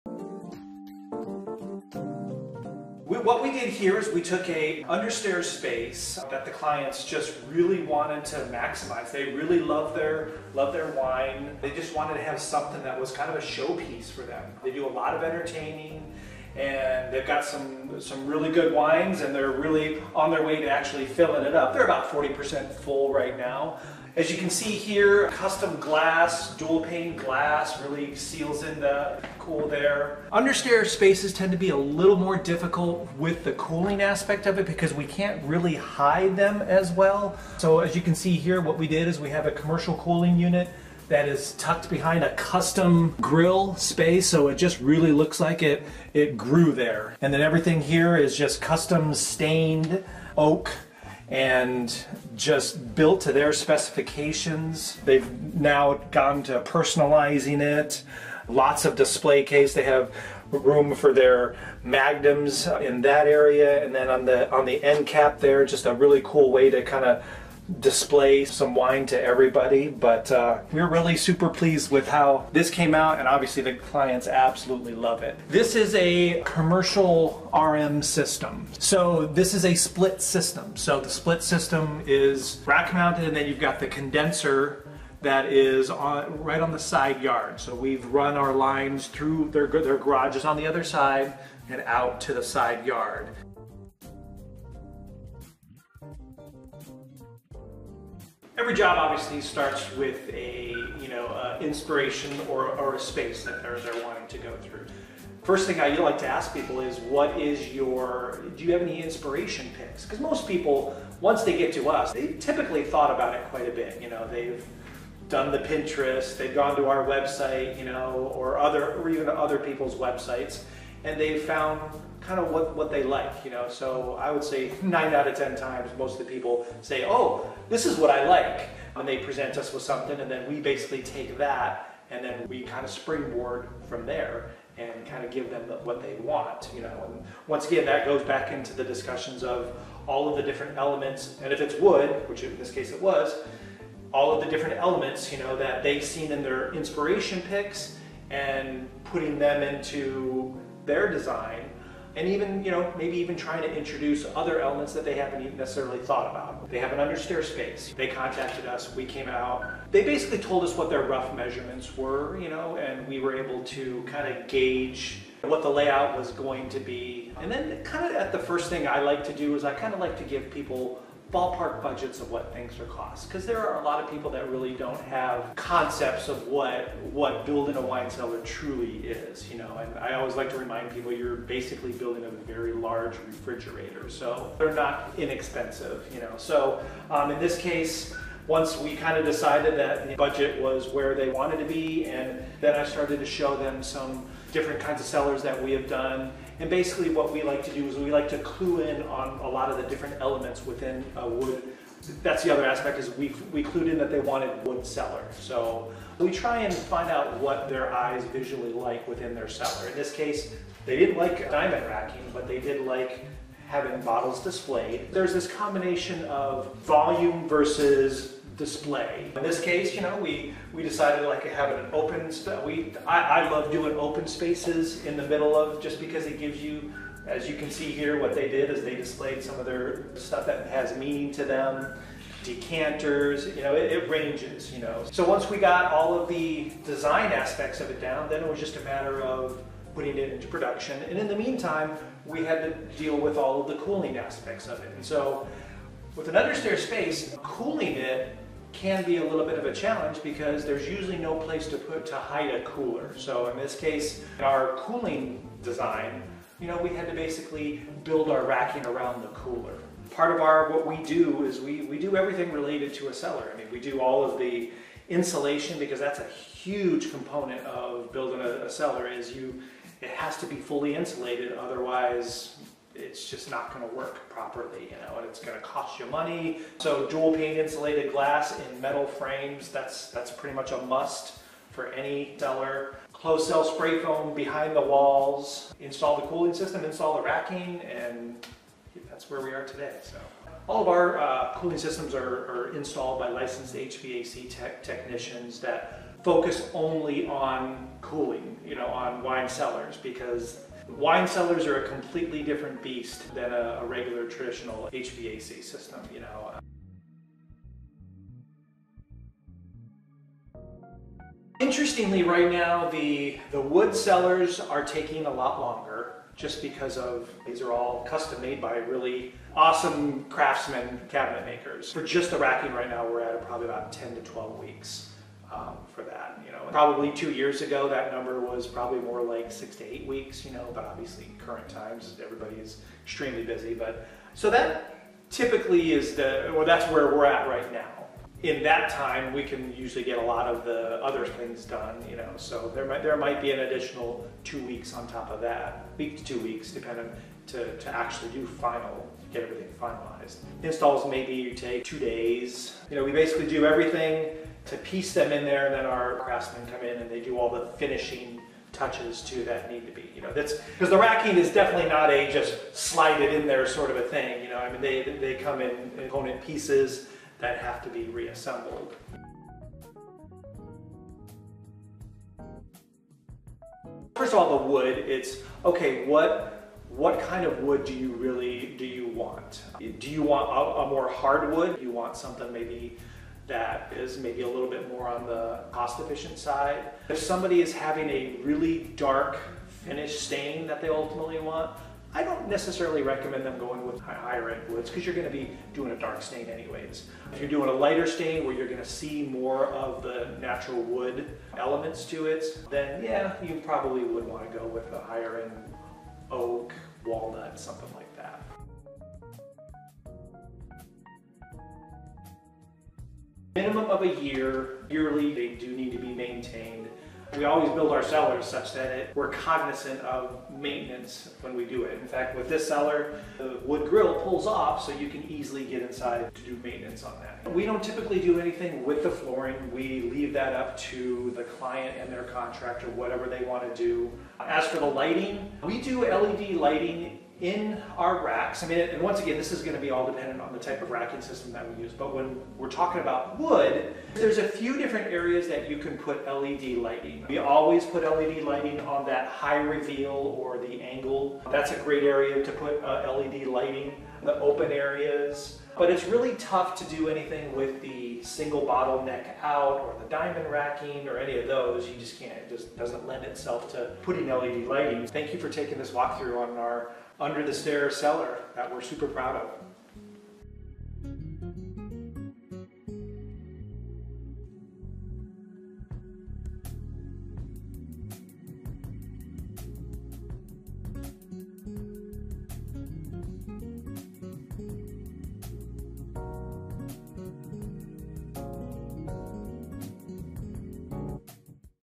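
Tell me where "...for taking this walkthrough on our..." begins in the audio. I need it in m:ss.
7:45.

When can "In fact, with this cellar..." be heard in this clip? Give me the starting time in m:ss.
7:02.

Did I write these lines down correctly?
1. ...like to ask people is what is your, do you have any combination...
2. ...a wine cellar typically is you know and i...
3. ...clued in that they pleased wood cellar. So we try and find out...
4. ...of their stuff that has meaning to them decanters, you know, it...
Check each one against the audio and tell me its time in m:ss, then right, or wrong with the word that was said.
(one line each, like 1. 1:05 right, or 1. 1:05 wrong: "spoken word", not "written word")
1. 1:45 wrong: "inspiration", not "combination"
2. 2:57 wrong: "truly", not "typically"
3. 3:23 wrong: "wanted", not "pleased"
4. 3:49 right.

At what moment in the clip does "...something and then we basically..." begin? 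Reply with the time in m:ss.
2:09.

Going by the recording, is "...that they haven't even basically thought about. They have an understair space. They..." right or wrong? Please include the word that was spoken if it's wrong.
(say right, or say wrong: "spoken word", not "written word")
wrong: "necessarily", not "basically".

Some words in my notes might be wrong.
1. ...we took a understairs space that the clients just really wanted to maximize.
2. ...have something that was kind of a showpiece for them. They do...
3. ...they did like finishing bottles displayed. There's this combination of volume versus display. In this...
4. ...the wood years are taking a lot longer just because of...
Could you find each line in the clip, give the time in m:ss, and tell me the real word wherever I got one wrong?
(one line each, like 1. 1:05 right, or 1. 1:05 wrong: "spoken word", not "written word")
1. 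0:04 right
2. 0:12 right
3. 3:32 wrong: "having", not "finishing"
4. 5:13 wrong: "cellars", not "years".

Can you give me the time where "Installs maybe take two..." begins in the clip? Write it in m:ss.
5:50.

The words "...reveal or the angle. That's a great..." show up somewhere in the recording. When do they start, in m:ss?
7:29.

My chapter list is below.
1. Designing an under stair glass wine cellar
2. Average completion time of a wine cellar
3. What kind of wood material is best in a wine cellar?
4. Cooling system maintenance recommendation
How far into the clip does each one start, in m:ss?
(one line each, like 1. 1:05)
1. 1:34
2. 5:08
3. 6:09
4. 6:51.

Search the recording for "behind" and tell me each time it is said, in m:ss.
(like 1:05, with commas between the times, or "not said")
0:41, 4:44.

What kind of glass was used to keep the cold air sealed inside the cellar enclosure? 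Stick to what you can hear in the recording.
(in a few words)
Dual pane glass.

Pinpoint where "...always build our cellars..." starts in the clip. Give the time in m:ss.
6:57.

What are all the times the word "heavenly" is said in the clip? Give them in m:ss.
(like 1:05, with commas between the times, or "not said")
not said.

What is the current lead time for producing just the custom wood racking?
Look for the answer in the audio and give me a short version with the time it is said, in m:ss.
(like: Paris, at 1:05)
10 to 12 weeks, at 5:23.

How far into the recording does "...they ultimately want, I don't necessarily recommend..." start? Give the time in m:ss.
6:30.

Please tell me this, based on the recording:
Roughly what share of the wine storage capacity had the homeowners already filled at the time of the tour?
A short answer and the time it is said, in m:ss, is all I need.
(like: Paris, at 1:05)
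40%, at 0:22.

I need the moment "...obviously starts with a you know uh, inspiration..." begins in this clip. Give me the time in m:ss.
1:38.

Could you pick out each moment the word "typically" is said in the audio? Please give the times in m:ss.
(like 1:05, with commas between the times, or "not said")
1:52, 5:35, 7:07.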